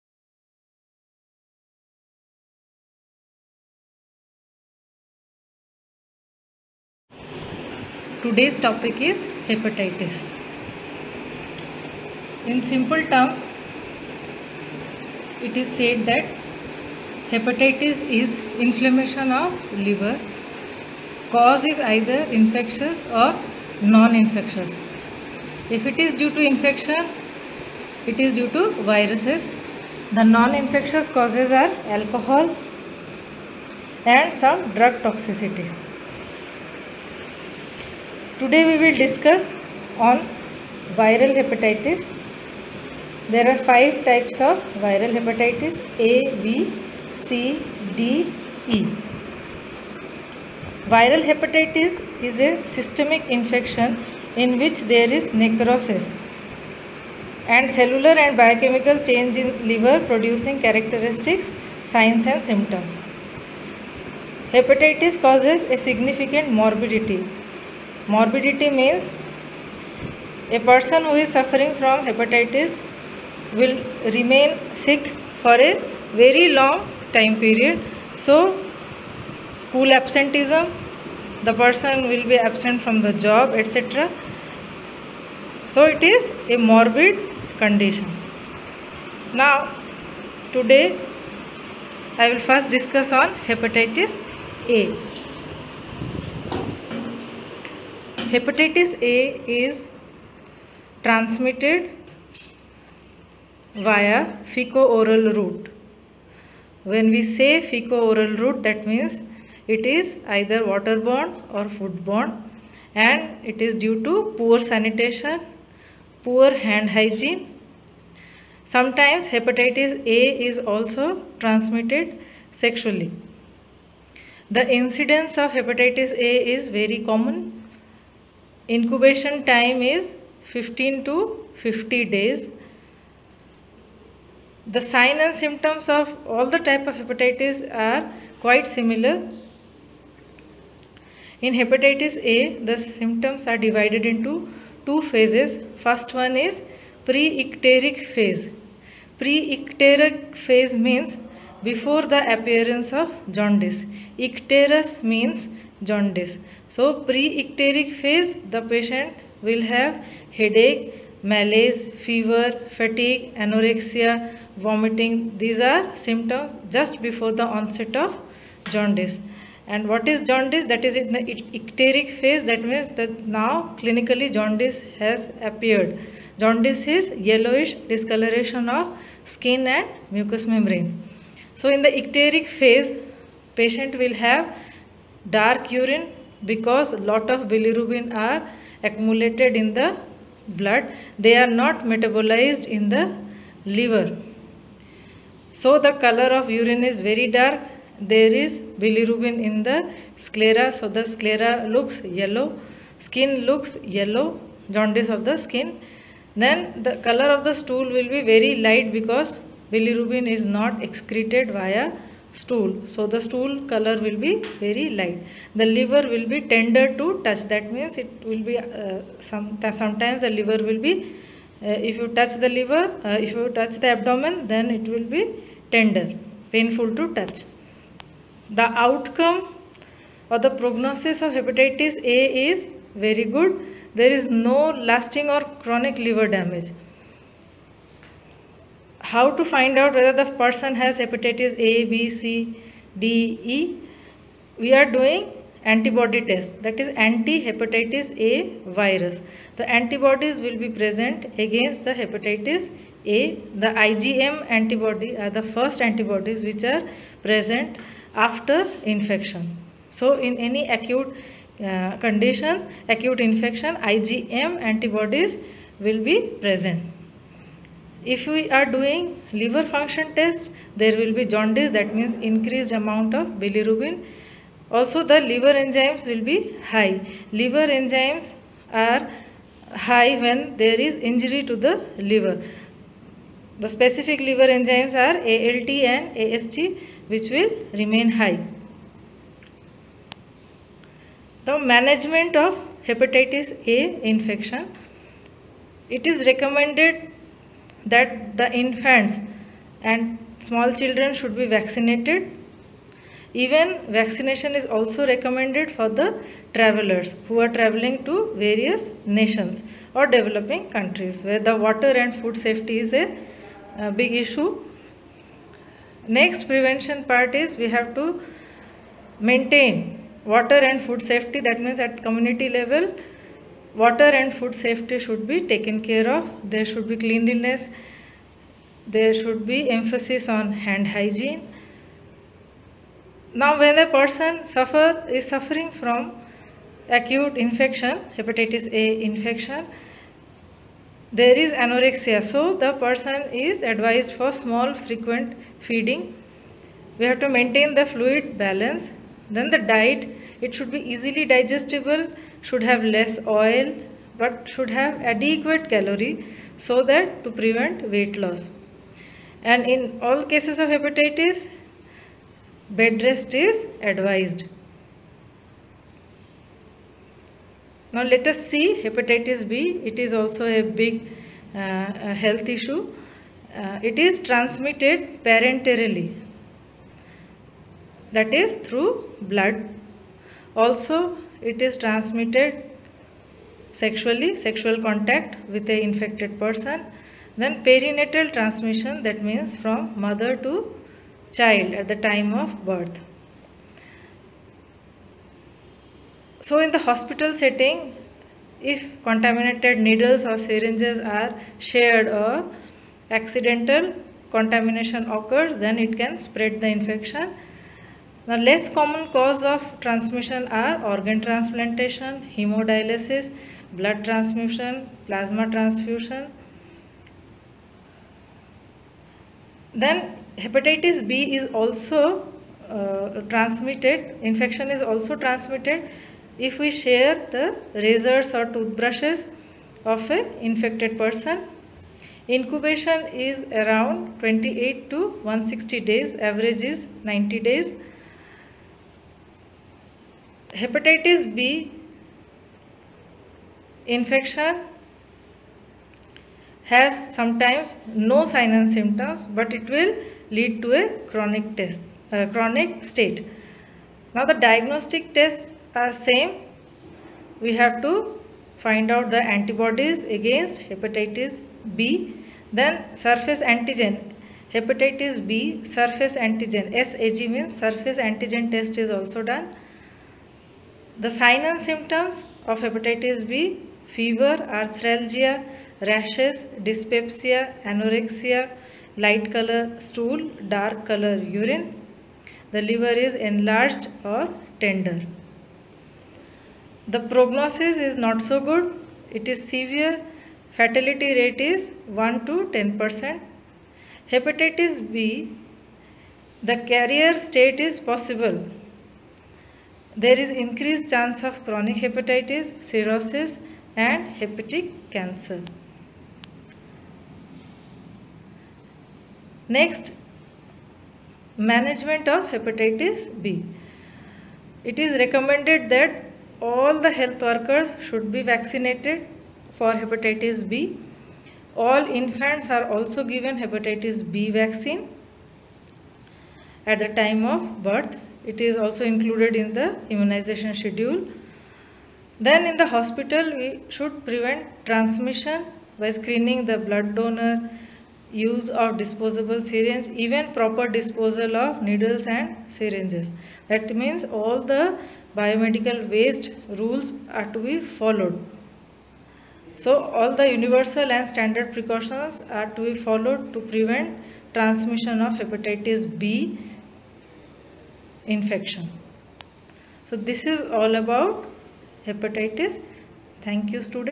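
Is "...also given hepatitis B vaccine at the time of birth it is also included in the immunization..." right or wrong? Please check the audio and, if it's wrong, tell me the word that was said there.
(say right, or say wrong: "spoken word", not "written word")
right.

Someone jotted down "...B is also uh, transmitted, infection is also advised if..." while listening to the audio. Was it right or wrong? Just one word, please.
wrong.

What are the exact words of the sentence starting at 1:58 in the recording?
Sometimes hepatitis A is also transmitted sexually.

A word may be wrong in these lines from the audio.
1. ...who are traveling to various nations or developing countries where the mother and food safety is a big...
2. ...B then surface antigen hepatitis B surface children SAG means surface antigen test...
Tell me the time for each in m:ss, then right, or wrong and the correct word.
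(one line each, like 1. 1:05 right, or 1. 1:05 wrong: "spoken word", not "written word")
1. 5:07 wrong: "water", not "mother"
2. 7:41 wrong: "antigen", not "children".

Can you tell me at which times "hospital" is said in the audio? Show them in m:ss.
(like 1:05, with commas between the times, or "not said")
6:36, 8:52.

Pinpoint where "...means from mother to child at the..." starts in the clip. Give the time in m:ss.
6:29.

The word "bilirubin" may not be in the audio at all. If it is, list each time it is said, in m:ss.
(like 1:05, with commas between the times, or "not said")
3:07, 3:18, 3:29, 4:33.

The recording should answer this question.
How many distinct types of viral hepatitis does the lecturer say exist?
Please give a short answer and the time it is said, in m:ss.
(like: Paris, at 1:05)
5, at 0:43.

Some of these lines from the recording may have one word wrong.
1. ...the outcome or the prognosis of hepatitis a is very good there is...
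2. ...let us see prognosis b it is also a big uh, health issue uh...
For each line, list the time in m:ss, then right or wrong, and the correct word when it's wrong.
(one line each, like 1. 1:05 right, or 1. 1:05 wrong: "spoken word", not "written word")
1. 3:48 right
2. 6:08 wrong: "hepatitis", not "prognosis".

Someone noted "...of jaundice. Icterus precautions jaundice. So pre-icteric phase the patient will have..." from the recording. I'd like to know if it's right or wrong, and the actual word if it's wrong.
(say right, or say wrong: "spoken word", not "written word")
wrong: "means", not "precautions".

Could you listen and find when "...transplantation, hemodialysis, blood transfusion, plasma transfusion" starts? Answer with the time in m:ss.
6:51.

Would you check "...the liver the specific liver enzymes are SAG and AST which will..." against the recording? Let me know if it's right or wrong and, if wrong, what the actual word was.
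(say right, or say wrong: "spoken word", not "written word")
wrong: "ALT", not "SAG".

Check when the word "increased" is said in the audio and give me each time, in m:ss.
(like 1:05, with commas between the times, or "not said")
4:32, 8:20.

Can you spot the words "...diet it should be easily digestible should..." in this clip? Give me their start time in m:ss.
5:49.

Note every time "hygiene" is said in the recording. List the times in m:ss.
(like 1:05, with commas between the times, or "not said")
1:56, 5:30.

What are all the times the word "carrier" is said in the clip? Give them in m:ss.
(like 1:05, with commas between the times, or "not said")
8:16.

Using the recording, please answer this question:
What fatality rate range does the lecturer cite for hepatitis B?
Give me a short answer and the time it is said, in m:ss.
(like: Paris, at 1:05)
1 to 10 percent, at 8:11.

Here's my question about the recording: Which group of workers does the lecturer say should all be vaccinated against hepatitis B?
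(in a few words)
Health workers.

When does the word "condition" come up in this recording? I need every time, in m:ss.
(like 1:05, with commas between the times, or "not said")
1:27, 4:22.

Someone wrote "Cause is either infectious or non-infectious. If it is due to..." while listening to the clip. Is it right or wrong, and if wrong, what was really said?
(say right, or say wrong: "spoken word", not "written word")
right.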